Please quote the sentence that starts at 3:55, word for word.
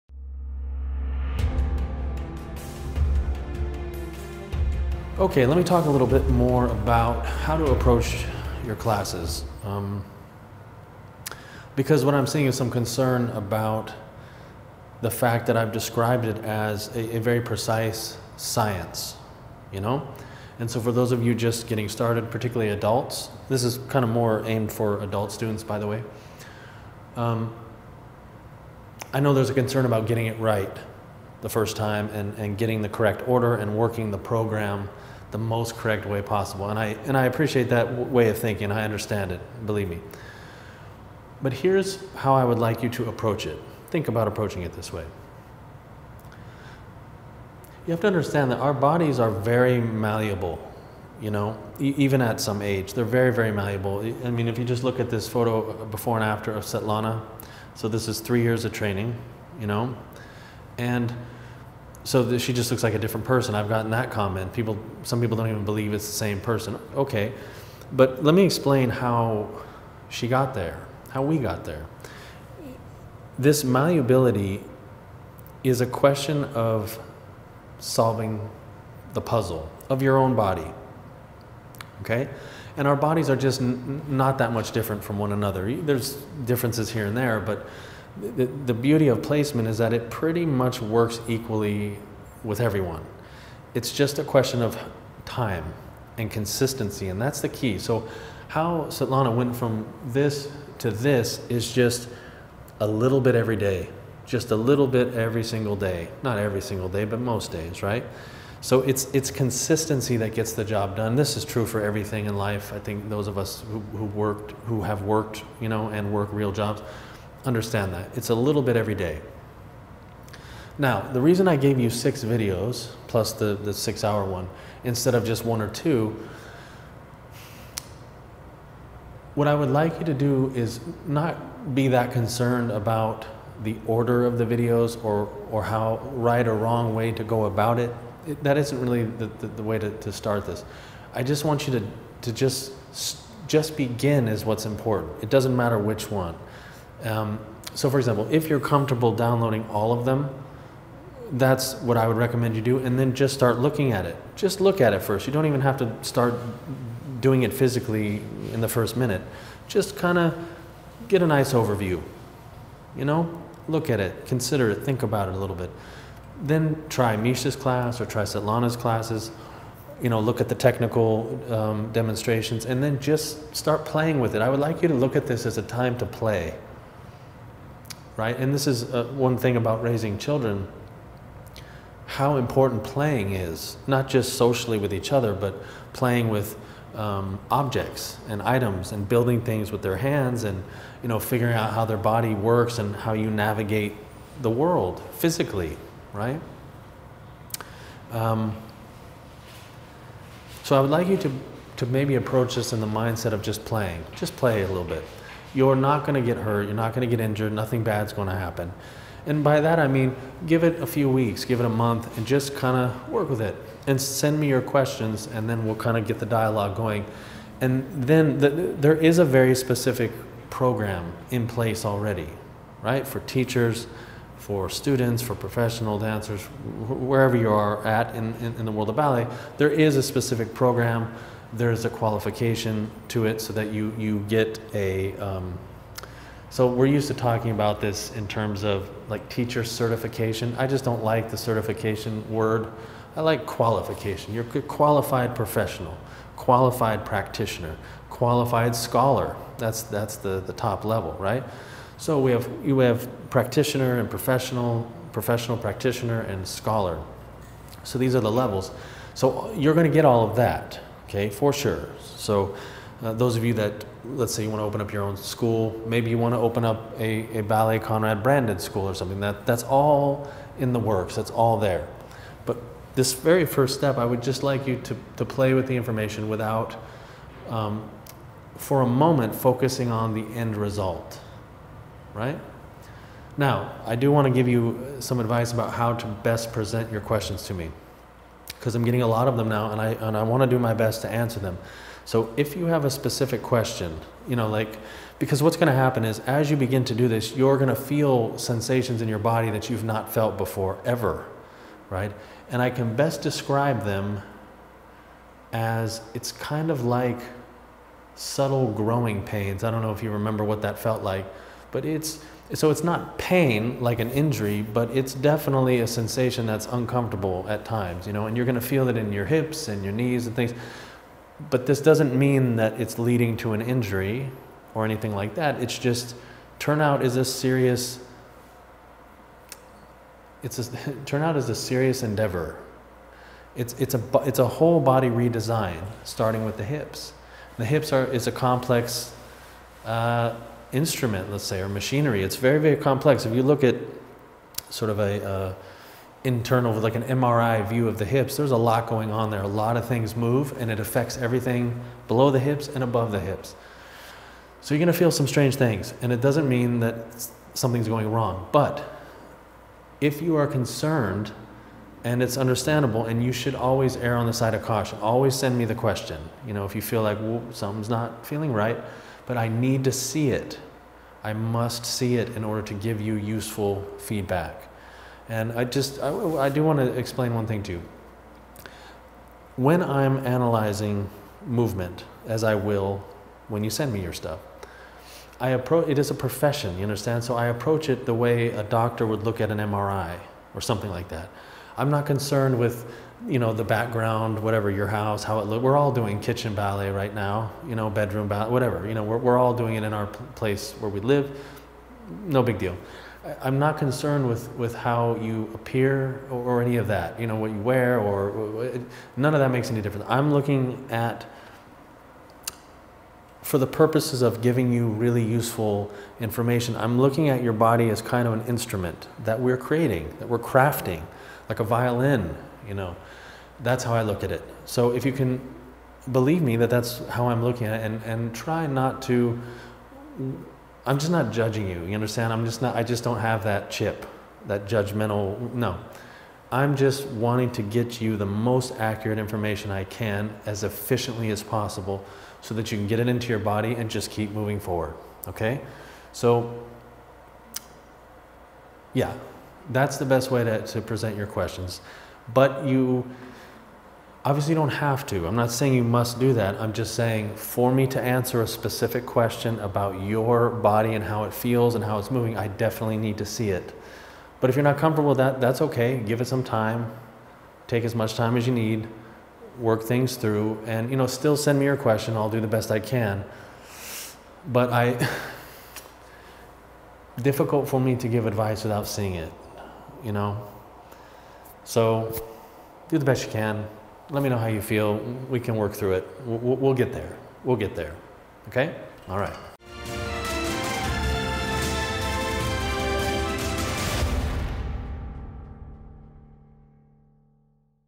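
Um, so we're used to talking about this in terms of like teacher certification.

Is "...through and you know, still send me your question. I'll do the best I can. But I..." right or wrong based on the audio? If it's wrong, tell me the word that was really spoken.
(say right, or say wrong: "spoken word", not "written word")
right.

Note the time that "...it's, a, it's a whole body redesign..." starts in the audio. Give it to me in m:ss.
5:33.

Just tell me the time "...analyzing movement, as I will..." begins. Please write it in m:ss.
6:20.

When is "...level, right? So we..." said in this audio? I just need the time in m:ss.
4:10.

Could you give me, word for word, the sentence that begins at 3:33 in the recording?
And send me your questions, and then we'll kind of get the dialogue going.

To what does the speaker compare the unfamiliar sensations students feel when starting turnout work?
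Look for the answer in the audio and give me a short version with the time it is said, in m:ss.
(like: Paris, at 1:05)
Subtle growing pains, at 5:08.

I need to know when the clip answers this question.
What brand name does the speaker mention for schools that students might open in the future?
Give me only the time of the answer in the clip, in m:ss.
4:27.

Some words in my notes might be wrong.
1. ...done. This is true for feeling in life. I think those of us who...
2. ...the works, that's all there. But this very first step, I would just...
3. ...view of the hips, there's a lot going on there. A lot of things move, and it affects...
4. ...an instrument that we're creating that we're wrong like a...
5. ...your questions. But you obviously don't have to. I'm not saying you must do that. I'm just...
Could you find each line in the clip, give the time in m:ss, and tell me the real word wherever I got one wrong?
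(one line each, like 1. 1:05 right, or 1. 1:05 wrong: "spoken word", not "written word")
1. 1:50 wrong: "everything", not "feeling"
2. 4:30 right
3. 5:47 right
4. 6:58 wrong: "crafting", not "wrong"
5. 7:31 right.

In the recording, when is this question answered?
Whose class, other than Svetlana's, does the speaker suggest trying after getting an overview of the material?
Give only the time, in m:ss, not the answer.
2:47.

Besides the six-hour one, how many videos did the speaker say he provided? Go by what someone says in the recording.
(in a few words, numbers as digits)
6.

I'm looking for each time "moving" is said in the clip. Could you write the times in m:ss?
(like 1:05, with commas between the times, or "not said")
7:24, 7:42.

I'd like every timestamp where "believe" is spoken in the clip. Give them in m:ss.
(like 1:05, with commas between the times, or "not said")
0:39, 1:05, 7:06.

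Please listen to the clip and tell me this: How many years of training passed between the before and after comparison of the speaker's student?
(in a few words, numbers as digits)
3.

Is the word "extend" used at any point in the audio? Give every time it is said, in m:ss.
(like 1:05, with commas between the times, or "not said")
not said.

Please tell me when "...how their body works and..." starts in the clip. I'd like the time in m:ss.
3:11.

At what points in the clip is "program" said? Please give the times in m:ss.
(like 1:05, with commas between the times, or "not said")
0:34, 3:40, 3:50.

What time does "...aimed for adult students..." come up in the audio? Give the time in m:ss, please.
0:24.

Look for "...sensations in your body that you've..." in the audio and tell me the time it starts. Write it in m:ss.
4:58.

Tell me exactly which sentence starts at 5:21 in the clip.
But this doesn't mean that it's leading to an injury or anything like that.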